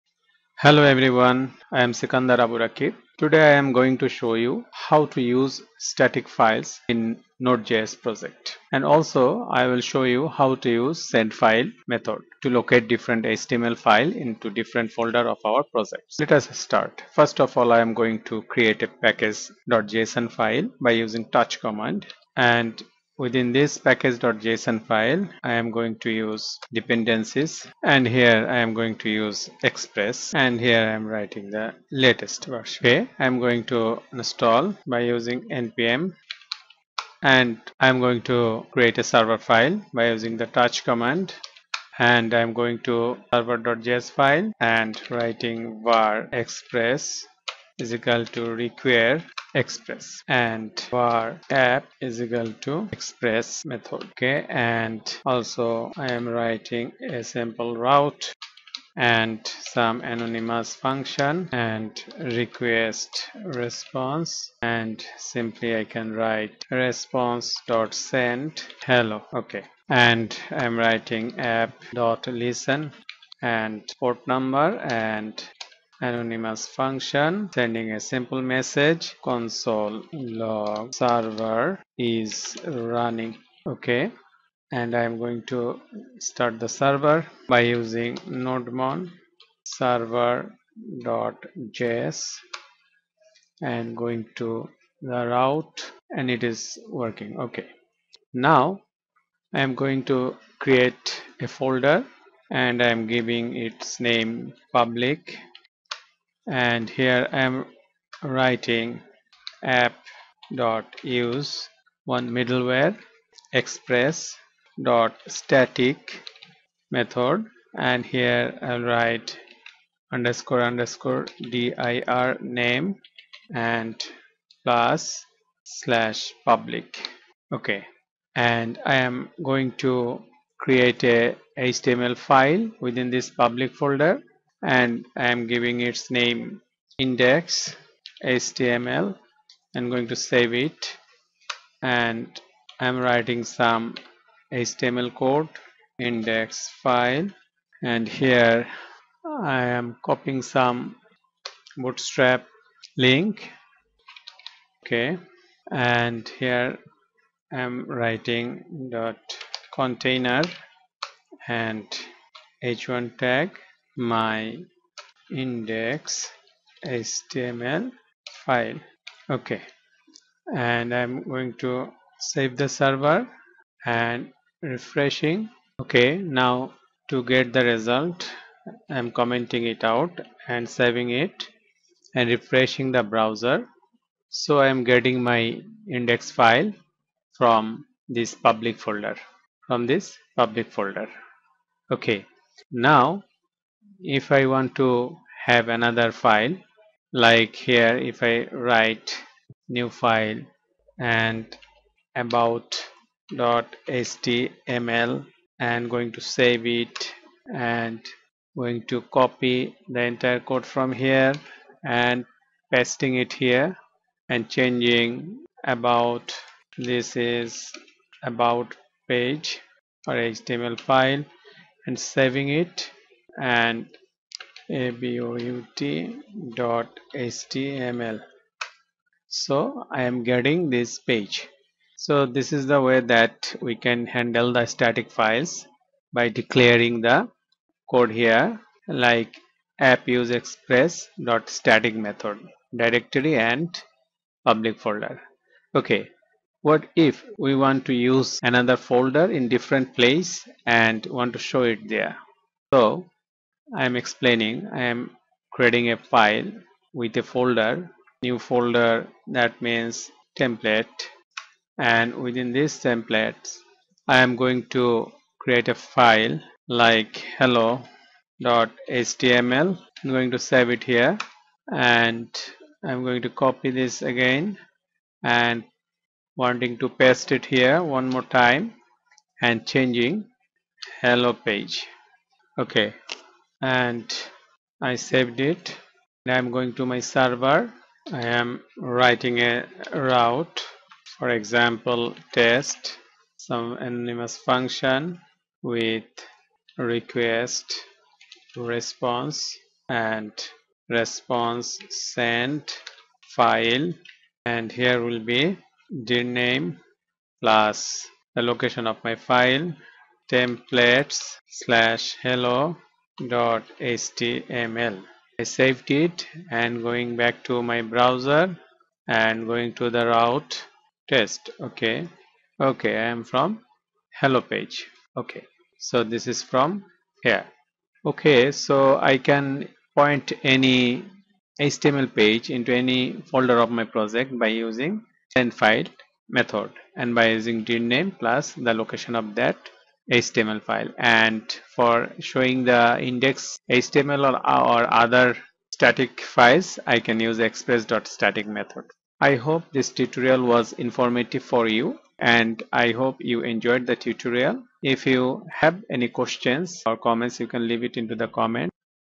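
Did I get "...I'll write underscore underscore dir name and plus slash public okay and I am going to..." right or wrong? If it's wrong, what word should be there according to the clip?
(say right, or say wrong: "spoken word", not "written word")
right.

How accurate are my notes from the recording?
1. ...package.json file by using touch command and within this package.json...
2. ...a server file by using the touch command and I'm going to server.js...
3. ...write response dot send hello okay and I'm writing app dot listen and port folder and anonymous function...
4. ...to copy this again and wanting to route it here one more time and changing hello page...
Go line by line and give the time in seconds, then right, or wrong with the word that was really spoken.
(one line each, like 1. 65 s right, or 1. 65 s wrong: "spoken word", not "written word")
1. 18 s right
2. 38 s right
3. 66 s wrong: "number", not "folder"
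4. 273 s wrong: "paste", not "route".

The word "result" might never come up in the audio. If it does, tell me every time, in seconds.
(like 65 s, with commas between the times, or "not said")
177 s.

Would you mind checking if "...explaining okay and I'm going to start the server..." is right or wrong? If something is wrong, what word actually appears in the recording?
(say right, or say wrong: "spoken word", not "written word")
wrong: "running", not "explaining".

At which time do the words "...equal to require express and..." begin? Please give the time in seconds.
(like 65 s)
47 s.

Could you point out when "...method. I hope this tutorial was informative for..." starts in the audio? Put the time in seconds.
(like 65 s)
348 s.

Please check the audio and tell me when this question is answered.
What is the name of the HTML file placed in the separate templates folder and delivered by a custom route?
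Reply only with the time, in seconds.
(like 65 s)
267 s.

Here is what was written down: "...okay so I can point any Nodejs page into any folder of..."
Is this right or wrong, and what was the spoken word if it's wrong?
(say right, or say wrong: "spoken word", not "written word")
wrong: "HTML", not "Nodejs".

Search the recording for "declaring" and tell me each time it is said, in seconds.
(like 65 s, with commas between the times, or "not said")
236 s.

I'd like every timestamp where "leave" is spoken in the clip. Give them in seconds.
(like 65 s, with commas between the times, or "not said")
357 s.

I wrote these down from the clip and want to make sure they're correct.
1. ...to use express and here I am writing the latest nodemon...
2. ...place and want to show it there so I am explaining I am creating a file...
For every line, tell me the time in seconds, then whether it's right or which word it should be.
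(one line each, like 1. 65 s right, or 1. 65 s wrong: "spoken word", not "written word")
1. 29 s wrong: "version", not "nodemon"
2. 249 s right.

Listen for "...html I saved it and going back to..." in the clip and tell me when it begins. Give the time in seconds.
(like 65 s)
313 s.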